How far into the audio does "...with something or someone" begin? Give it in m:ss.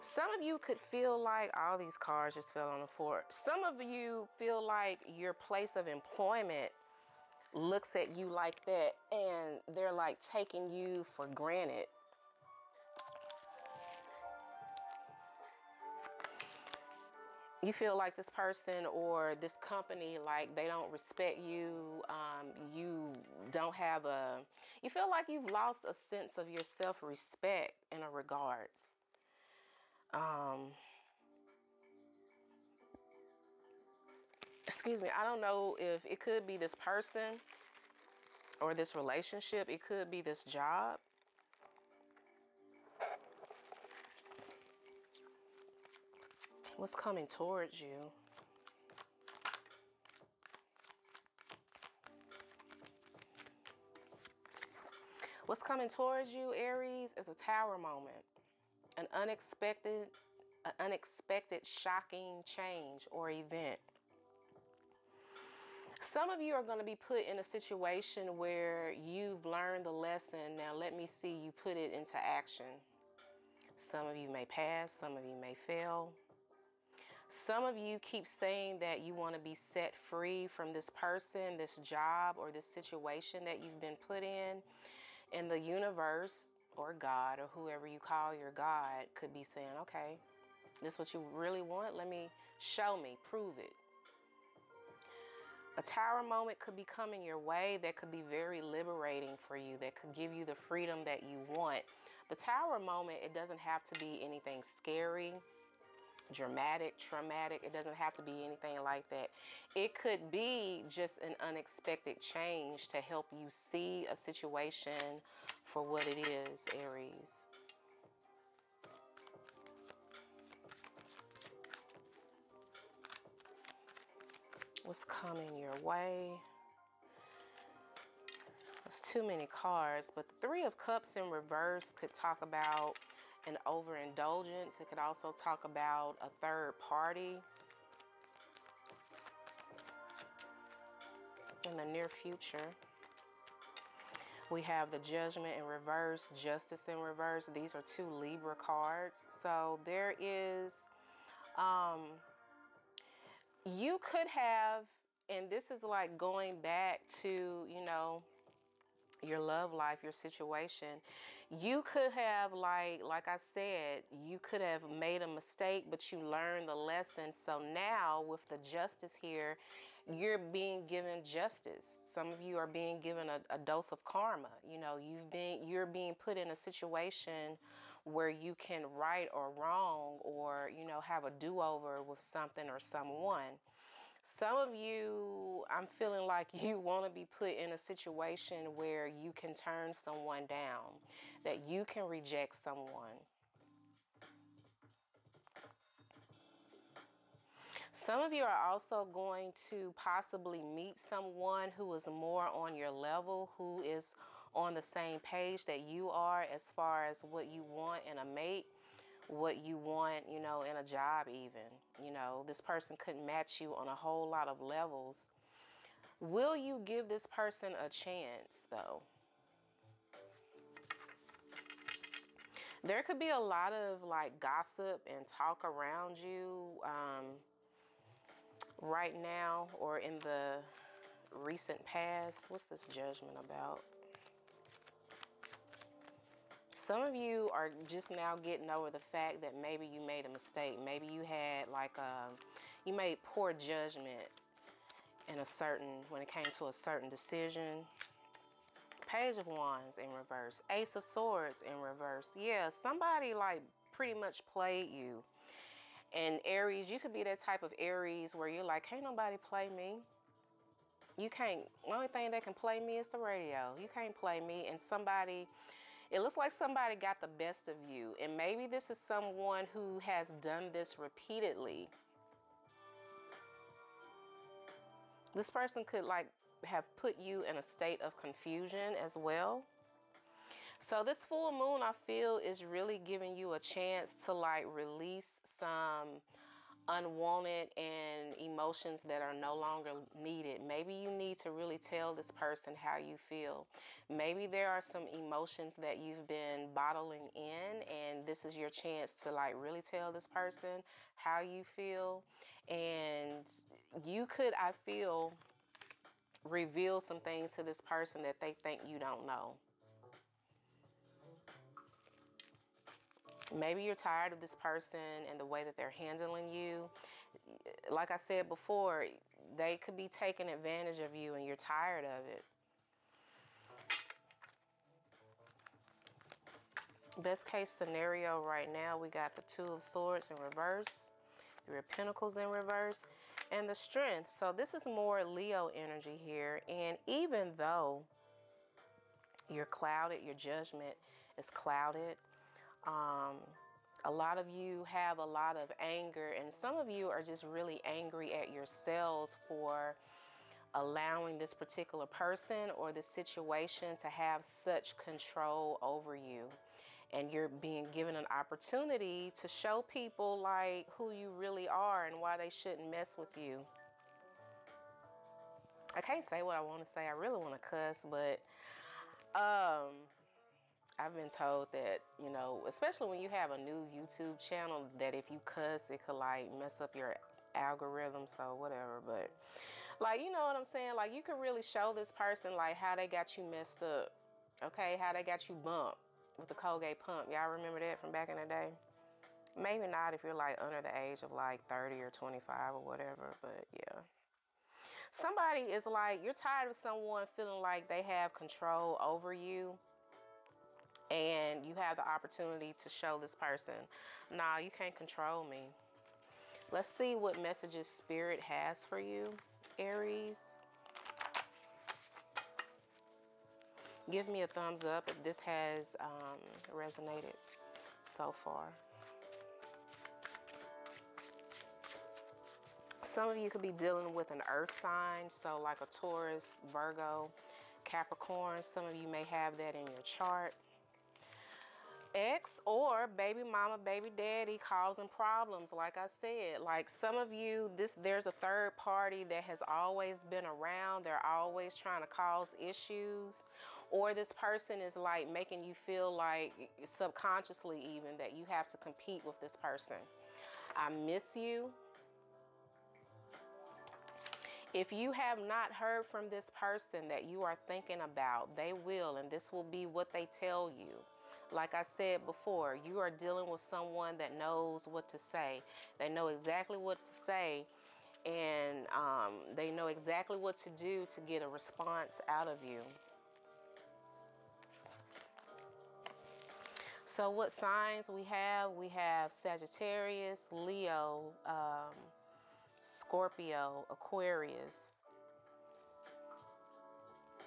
3:02.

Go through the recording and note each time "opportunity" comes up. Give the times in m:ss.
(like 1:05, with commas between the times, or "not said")
5:58, 6:42.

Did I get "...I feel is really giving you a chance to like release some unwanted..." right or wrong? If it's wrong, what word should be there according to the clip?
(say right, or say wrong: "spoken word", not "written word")
right.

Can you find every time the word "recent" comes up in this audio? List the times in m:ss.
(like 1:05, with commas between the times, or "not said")
3:51.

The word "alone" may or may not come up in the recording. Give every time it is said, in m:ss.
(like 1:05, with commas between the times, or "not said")
not said.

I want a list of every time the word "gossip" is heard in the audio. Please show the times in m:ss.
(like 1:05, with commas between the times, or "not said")
3:44.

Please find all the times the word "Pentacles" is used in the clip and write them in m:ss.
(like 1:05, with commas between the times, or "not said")
5:31.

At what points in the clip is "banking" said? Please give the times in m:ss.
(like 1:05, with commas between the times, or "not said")
not said.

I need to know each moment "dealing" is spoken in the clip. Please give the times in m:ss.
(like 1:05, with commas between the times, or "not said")
7:03, 7:43.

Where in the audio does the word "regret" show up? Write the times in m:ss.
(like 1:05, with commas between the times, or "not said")
not said.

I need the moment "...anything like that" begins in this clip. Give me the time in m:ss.
1:48.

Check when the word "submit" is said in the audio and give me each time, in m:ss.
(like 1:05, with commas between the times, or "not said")
not said.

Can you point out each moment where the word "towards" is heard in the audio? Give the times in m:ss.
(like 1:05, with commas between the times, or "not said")
0:47, 0:55.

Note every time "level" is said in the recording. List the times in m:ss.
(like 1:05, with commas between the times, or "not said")
3:22, 3:34.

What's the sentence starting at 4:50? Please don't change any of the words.
Maybe you need to really tell this person how you feel.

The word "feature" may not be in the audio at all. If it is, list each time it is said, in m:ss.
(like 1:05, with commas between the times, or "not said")
not said.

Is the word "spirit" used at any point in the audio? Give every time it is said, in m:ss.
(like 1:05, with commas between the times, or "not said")
6:47.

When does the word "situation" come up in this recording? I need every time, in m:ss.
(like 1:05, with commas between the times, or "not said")
1:07, 1:22, 1:54, 2:40, 2:56, 3:07, 5:53.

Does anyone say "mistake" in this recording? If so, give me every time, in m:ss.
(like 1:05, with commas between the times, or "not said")
2:45, 4:00.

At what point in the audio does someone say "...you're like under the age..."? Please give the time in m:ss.
6:30.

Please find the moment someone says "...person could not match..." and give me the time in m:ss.
3:32.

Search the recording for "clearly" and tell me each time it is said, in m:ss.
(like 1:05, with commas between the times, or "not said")
not said.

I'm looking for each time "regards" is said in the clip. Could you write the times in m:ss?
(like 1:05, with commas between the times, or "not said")
0:28.